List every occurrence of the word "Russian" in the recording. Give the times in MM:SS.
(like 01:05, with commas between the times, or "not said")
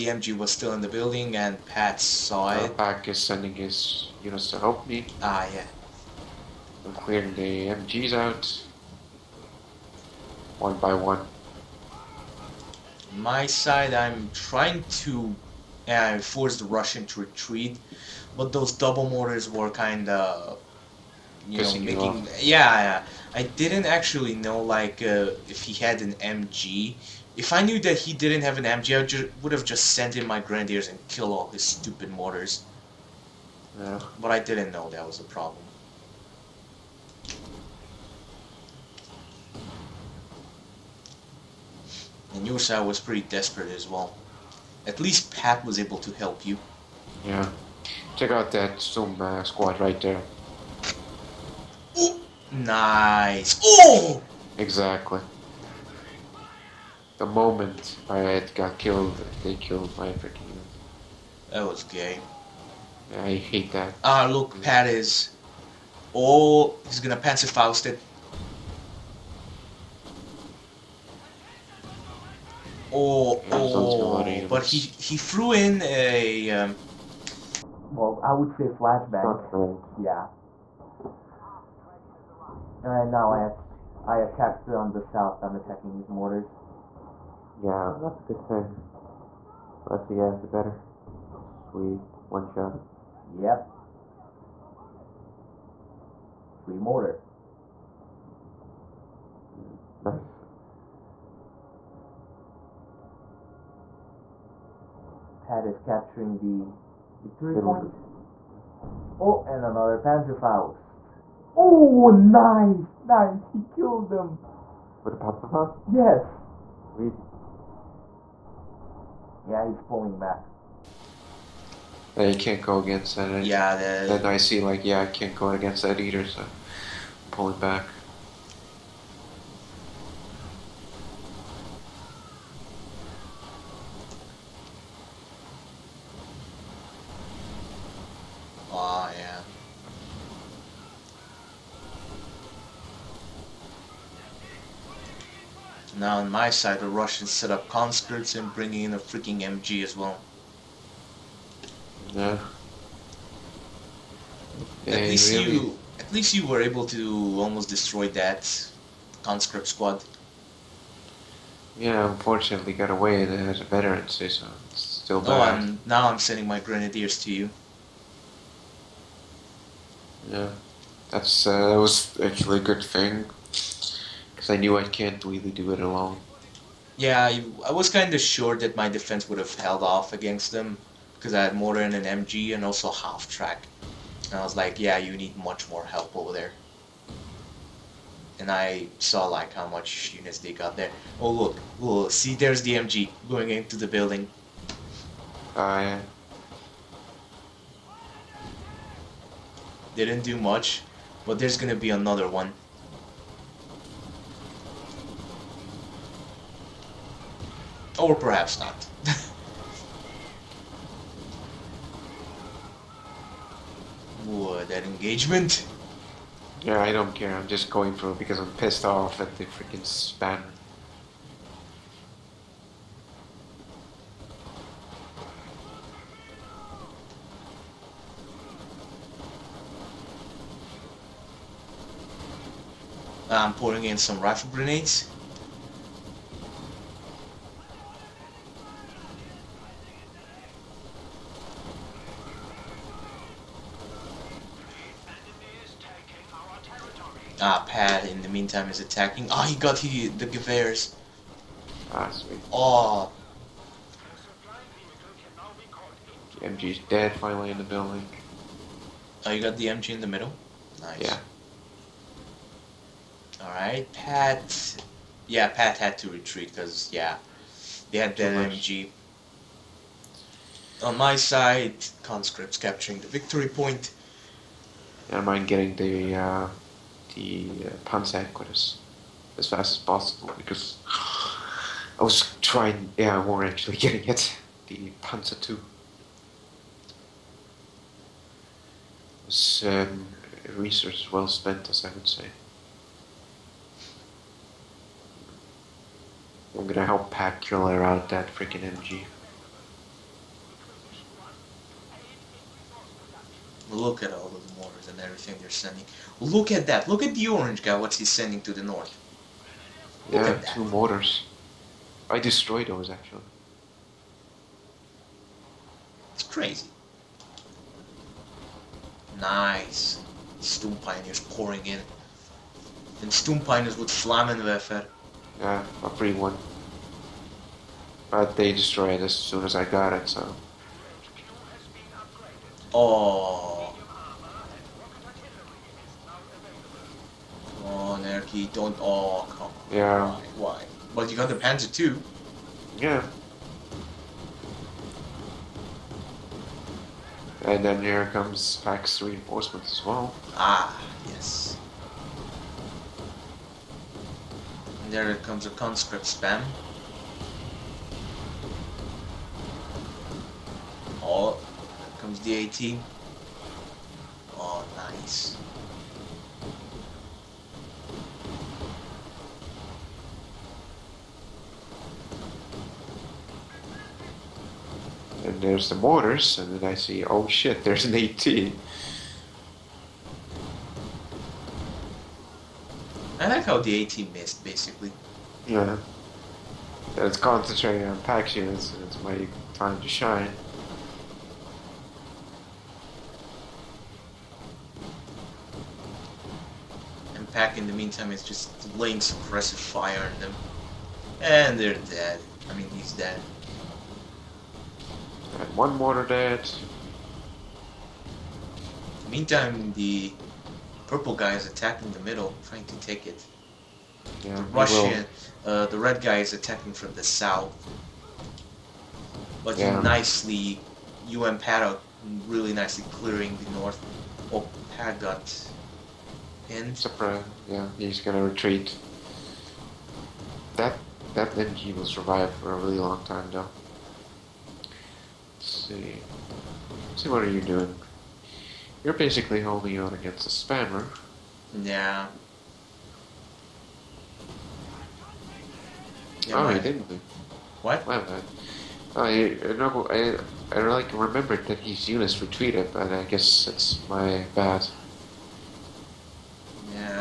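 00:16, 02:26, 06:54.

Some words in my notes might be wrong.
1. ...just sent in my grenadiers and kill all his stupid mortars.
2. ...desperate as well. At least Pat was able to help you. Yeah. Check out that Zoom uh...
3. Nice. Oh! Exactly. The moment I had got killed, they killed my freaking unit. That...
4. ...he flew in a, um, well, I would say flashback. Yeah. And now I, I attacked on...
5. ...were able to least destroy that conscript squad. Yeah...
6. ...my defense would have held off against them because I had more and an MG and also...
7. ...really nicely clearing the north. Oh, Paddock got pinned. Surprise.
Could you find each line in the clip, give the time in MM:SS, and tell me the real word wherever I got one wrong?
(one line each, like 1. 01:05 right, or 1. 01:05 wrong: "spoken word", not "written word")
1. 00:29 right
2. 00:43 right
3. 00:52 right
4. 01:14 right
5. 02:36 wrong: "almost", not "least"
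6. 02:58 right
7. 07:02 right.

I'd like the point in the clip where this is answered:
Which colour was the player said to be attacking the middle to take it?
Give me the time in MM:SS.
06:50.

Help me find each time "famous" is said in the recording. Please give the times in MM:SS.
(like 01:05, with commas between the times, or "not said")
not said.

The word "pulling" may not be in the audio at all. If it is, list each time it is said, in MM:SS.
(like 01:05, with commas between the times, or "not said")
01:59, 02:07, 03:53.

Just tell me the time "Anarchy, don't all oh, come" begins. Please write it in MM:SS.
05:38.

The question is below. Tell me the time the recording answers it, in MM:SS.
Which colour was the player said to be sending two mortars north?
05:07.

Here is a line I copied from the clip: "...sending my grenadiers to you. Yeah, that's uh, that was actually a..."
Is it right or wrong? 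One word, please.
right.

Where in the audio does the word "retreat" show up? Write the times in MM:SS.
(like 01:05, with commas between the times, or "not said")
00:17, 04:26, 07:08.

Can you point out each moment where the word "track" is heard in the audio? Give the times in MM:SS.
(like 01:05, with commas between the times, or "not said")
03:03.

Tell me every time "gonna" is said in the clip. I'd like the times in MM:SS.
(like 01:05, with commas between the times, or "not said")
01:06, 03:21, 04:56, 07:07.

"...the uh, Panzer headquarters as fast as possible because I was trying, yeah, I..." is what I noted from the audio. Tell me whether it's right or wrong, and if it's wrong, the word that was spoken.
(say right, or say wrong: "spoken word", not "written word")
right.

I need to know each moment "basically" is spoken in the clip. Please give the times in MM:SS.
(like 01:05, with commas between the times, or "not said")
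06:24, 07:18.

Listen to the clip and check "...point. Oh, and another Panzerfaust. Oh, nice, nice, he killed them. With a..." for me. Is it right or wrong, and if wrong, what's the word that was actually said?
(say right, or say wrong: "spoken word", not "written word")
right.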